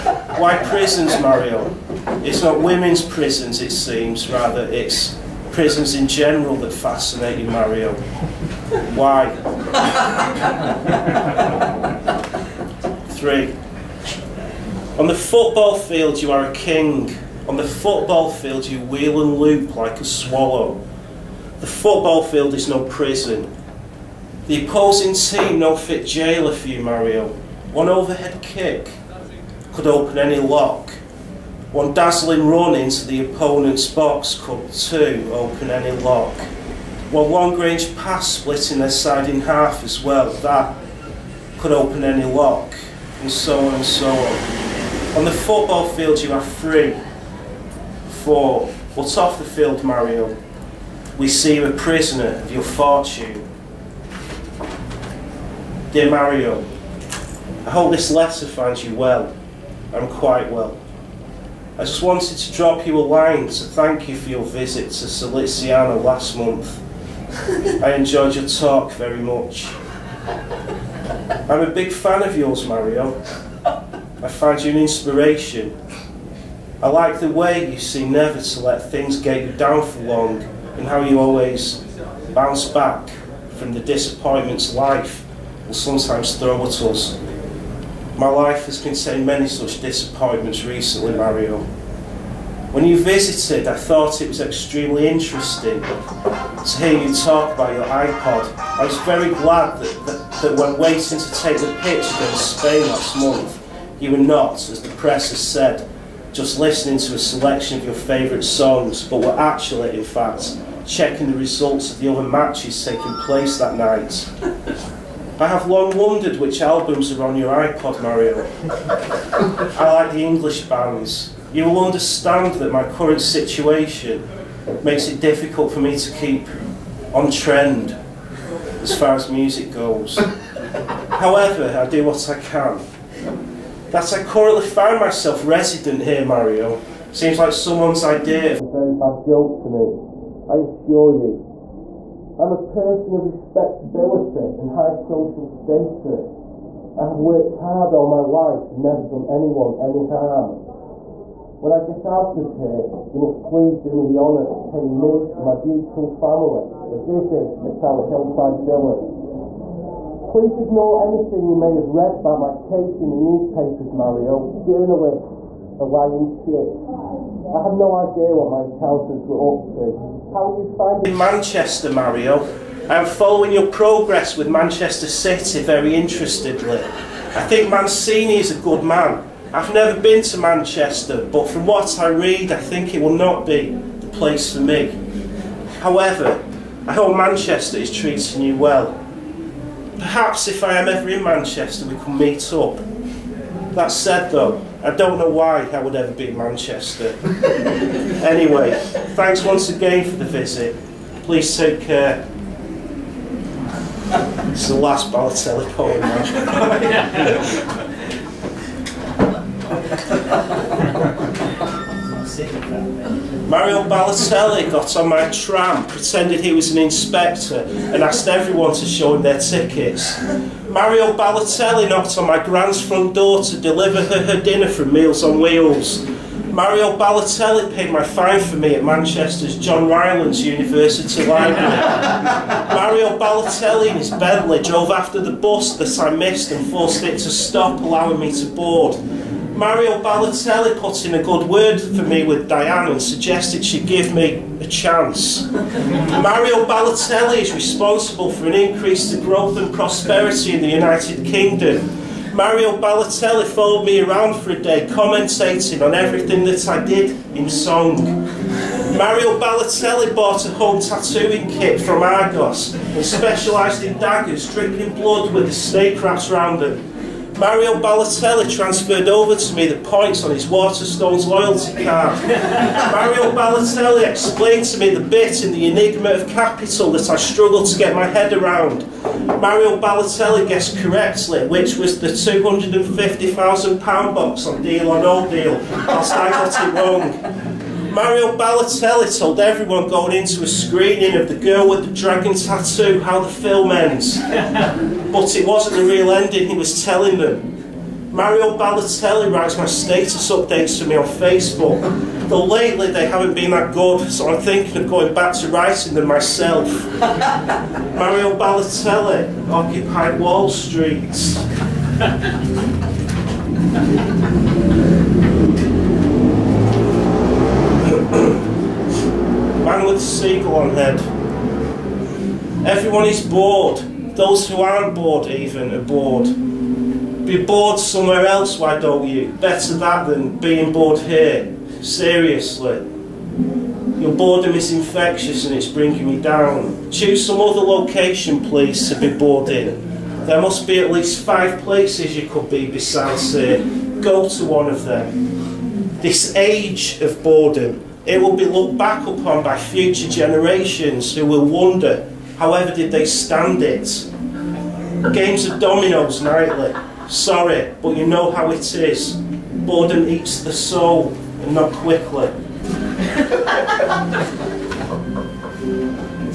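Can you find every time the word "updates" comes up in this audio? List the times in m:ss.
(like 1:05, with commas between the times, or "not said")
5:00.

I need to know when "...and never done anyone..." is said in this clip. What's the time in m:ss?
2:28.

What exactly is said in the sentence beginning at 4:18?
Mario Balotelli bought a home tattooing kit from Argos and specialised in daggers, dripping blood with the snake wrapped round them.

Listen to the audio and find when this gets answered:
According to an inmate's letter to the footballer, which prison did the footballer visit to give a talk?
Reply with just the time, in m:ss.
1:05.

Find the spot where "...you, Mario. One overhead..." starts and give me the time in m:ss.
0:26.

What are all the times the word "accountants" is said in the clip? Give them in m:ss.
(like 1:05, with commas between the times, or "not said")
2:48.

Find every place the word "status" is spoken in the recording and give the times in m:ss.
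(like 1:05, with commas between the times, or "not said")
2:25, 4:59.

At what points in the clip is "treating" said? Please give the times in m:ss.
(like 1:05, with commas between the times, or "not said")
3:07.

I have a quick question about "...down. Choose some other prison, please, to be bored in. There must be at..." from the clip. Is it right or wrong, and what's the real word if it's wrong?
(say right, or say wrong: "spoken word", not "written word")
wrong: "location", not "prison".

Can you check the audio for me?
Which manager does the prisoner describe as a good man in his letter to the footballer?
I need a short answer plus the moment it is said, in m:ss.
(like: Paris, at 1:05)
Mancini, at 2:57.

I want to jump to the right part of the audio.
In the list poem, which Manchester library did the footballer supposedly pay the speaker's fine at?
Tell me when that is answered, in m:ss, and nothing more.
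3:49.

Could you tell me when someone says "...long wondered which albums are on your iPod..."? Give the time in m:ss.
1:55.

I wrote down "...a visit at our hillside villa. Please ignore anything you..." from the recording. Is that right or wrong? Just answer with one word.
right.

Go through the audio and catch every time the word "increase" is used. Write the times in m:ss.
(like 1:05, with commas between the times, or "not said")
4:08.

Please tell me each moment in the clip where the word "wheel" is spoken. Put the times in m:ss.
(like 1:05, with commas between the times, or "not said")
0:18, 3:45.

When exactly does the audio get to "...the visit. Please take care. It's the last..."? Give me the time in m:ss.
3:20.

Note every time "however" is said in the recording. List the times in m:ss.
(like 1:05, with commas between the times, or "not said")
2:11, 3:05, 5:52.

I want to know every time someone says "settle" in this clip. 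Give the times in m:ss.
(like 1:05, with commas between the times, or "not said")
not said.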